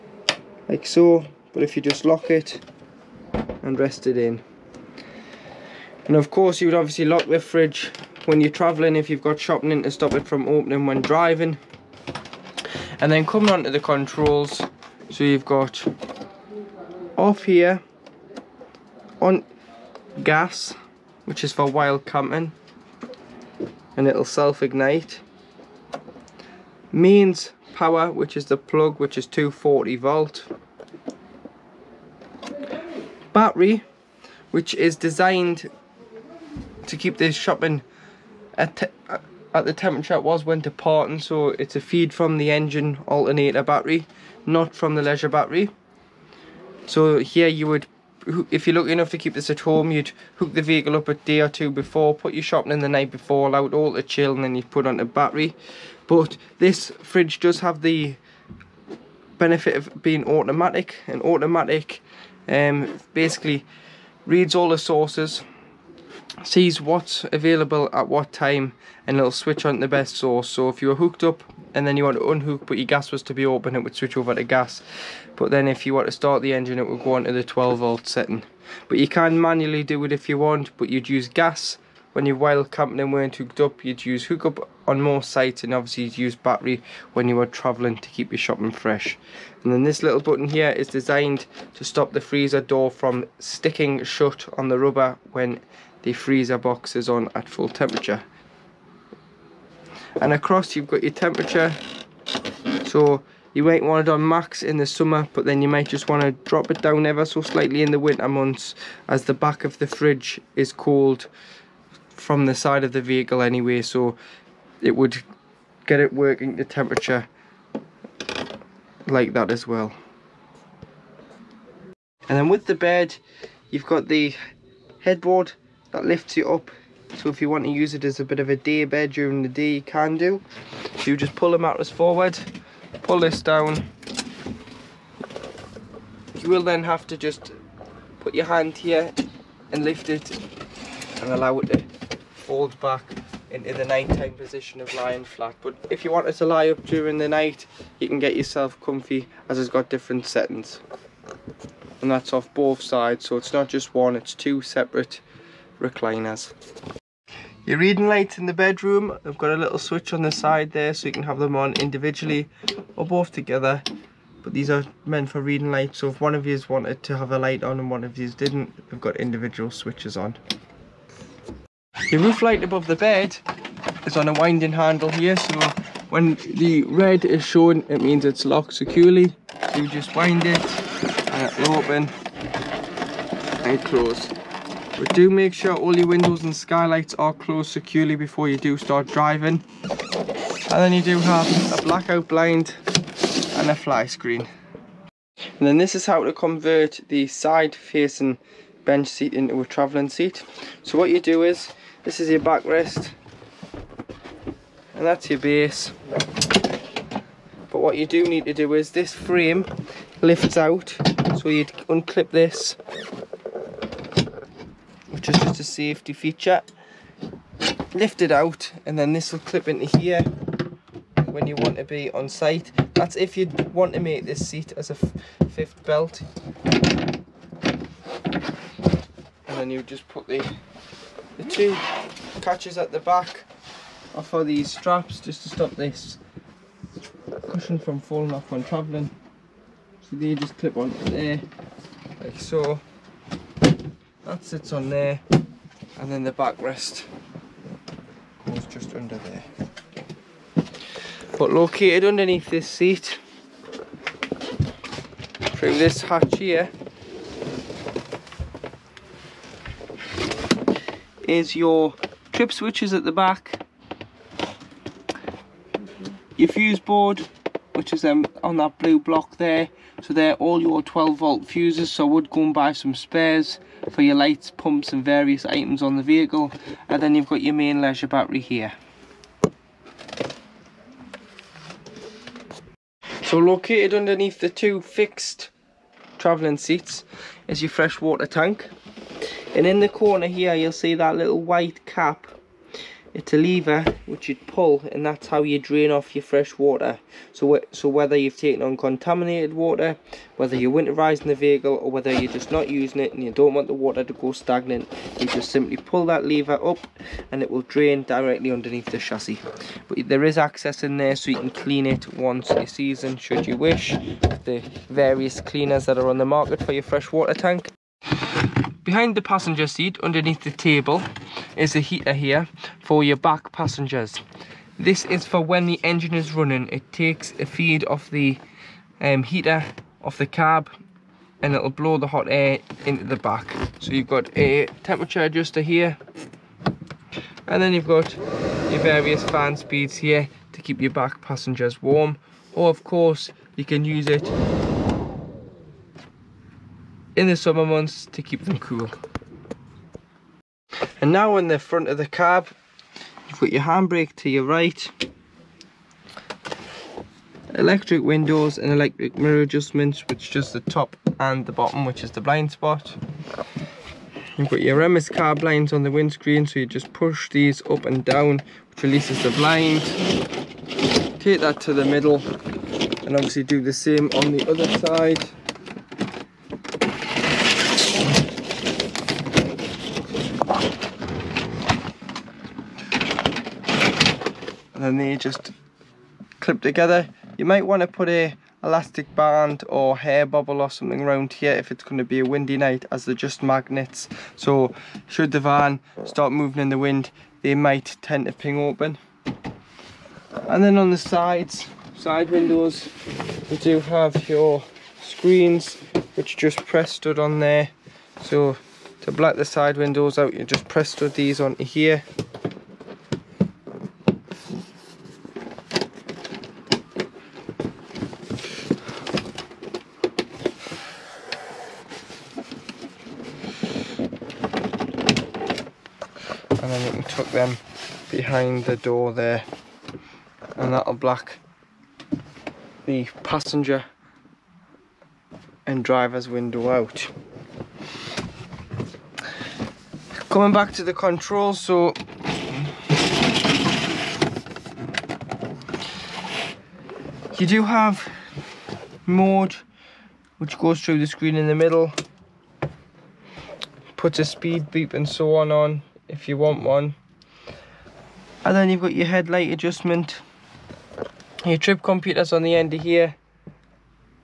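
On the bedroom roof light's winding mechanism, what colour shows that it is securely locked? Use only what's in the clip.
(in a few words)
red.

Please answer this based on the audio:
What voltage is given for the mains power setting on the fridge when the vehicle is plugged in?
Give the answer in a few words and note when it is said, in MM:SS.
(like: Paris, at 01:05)
240 volt, at 00:29.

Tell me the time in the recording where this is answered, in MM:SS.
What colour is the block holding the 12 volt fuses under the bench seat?
04:28.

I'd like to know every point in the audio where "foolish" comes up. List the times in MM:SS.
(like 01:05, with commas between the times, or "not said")
not said.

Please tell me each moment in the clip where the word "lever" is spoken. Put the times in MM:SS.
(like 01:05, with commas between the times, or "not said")
04:53, 05:06.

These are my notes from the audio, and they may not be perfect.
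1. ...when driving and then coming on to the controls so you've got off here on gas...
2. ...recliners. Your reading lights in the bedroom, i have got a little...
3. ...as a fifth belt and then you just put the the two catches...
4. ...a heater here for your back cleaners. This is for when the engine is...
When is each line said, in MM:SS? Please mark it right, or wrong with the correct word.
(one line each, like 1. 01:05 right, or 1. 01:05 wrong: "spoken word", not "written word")
1. 00:10 right
2. 02:35 right
3. 03:44 right
4. 05:21 wrong: "passengers", not "cleaners".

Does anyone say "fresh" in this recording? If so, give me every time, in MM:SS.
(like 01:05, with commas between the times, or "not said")
01:28, 04:47, 04:56, 05:16.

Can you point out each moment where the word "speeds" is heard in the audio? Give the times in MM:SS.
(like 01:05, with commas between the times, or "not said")
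05:39, 07:34.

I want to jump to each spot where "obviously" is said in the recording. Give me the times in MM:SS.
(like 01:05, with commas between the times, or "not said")
00:06, 01:25, 06:13.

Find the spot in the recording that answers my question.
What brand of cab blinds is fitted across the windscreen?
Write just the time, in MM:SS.
06:04.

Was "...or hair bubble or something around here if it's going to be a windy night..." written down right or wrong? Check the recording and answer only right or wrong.
right.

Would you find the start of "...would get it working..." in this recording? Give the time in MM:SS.
01:54.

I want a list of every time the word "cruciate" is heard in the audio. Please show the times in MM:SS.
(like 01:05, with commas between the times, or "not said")
not said.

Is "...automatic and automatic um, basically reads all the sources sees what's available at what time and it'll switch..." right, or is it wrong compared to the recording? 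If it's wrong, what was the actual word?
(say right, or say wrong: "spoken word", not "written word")
right.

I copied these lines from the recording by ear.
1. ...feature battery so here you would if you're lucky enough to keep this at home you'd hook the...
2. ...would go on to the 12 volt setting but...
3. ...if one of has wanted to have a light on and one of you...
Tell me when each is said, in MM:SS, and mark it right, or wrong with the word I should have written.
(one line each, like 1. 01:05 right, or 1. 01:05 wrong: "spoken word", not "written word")
1. 00:45 wrong: "leisure", not "feature"
2. 01:16 right
3. 02:46 right.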